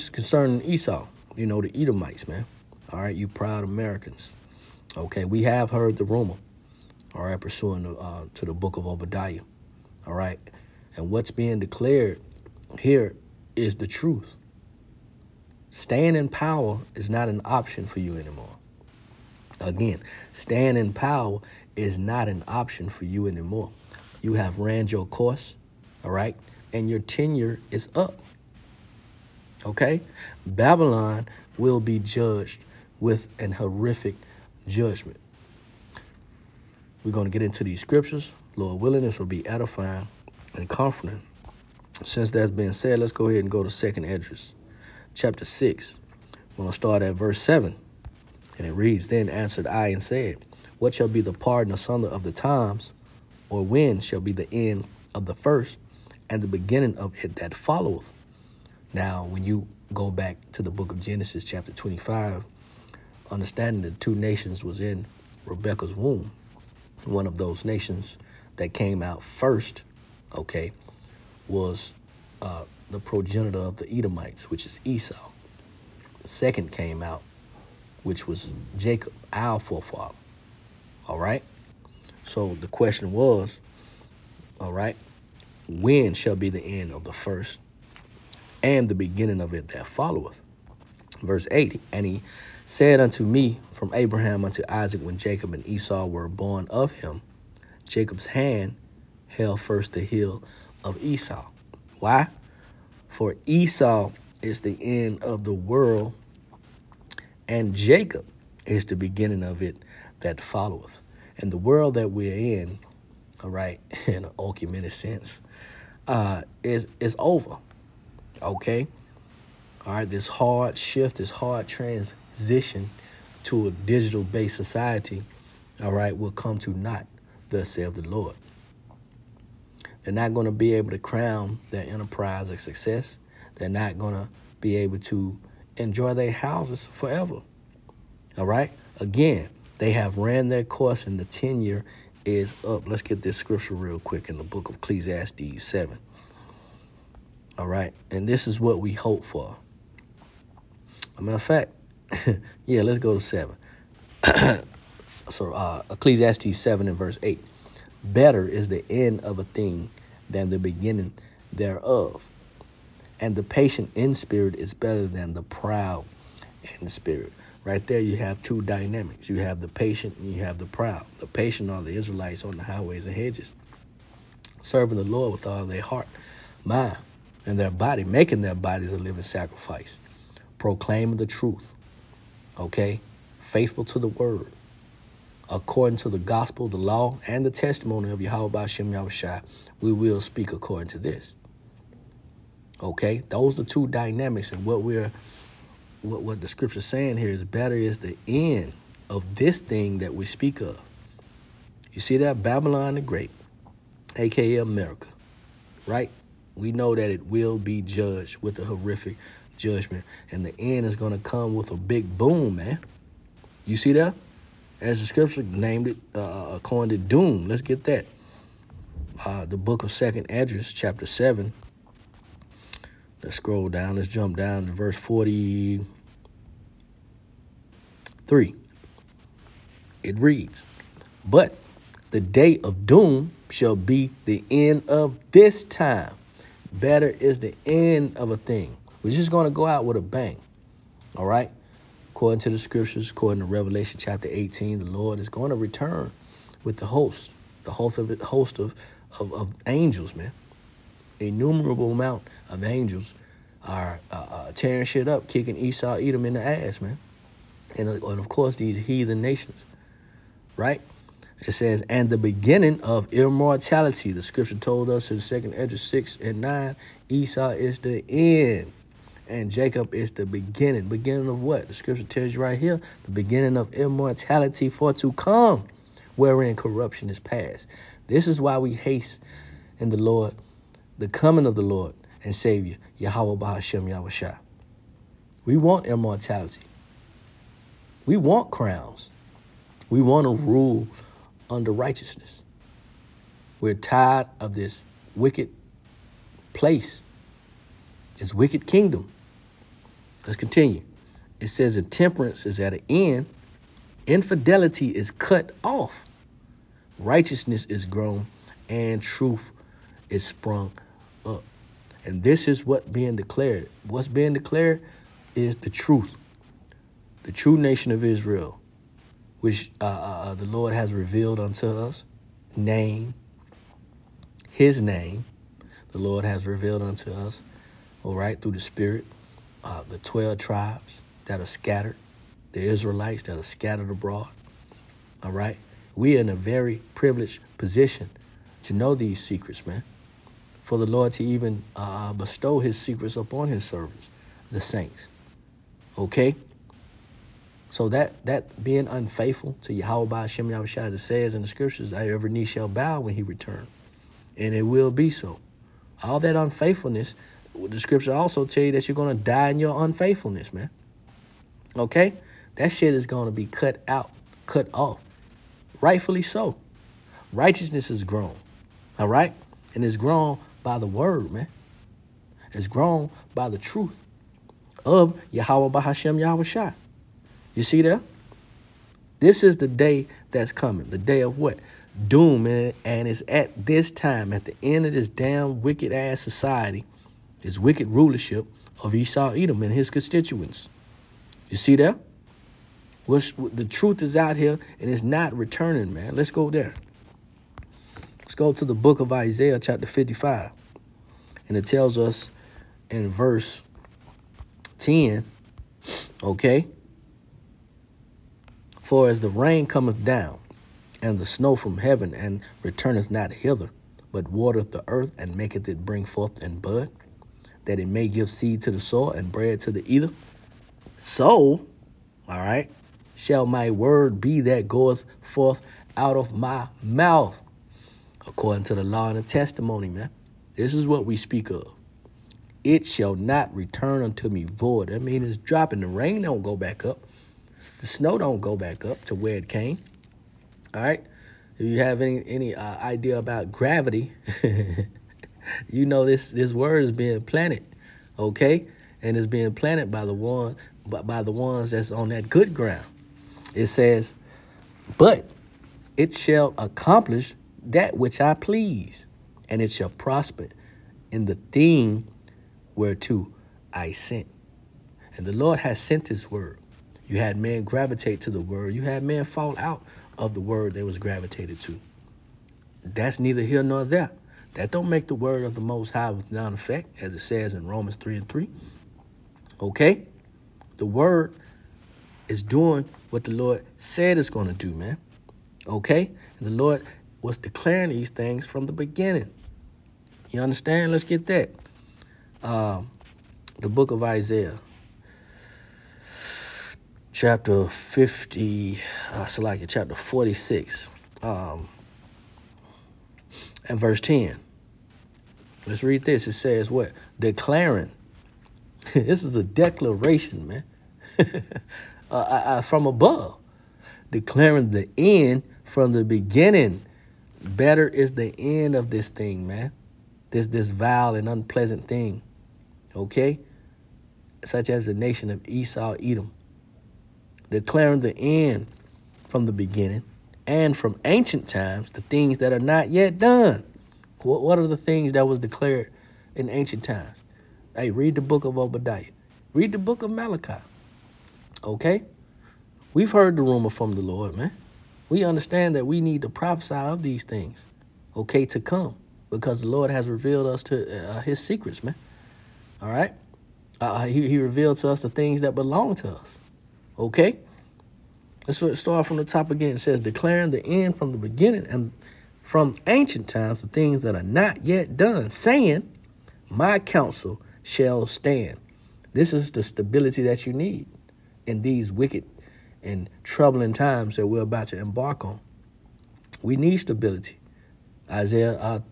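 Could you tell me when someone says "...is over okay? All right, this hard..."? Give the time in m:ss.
1:56.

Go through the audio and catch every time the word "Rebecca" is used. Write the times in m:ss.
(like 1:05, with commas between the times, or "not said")
1:05.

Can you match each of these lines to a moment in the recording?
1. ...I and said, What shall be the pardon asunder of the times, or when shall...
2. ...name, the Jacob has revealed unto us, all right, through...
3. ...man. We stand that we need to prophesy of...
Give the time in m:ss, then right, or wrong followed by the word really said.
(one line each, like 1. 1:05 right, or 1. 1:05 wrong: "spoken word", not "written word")
1. 0:49 right
2. 5:24 wrong: "Lord", not "Jacob"
3. 9:04 wrong: "understand", not "stand".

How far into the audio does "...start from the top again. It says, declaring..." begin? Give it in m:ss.
9:18.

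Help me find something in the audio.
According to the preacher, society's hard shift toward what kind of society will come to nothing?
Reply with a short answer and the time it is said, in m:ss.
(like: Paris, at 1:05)
Digital-based, at 2:03.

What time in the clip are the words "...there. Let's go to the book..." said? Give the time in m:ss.
6:36.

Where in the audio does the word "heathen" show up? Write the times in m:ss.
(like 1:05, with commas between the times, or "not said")
4:18.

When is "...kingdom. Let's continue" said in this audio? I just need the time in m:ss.
4:58.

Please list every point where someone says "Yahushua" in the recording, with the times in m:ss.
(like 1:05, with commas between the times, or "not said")
3:08, 4:43, 5:50.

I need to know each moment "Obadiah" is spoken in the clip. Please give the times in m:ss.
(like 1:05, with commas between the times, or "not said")
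0:08, 8:58.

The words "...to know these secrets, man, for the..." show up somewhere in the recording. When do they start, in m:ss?
5:38.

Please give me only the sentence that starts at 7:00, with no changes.
So, all right, shall my word be that goeth forth out of my mouth, according to the law and the testimony, man.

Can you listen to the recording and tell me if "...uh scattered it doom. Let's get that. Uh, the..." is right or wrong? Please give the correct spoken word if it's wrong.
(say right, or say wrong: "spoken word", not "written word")
wrong: "coined", not "scattered".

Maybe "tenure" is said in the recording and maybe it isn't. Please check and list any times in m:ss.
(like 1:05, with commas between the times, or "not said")
0:26, 2:21.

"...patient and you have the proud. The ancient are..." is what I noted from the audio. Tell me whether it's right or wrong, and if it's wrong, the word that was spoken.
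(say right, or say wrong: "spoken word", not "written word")
wrong: "patient", not "ancient".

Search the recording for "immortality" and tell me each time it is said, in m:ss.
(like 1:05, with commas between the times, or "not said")
4:23, 4:33, 4:45.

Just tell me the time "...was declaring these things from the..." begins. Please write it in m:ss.
8:07.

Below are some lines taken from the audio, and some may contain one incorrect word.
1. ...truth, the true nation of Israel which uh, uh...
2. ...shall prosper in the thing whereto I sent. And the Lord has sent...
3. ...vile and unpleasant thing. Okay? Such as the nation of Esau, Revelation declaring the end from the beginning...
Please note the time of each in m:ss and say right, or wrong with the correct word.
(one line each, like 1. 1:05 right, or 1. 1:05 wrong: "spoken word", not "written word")
1. 5:15 right
2. 7:39 right
3. 8:40 wrong: "Edom", not "Revelation".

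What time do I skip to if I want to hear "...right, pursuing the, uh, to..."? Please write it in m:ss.
0:07.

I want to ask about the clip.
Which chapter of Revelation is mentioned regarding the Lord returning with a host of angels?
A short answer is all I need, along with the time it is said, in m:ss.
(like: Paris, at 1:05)
18, at 4:03.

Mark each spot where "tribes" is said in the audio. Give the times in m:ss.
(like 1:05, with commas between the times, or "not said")
5:30.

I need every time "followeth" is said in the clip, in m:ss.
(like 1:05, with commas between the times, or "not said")
0:57, 1:29, 1:50.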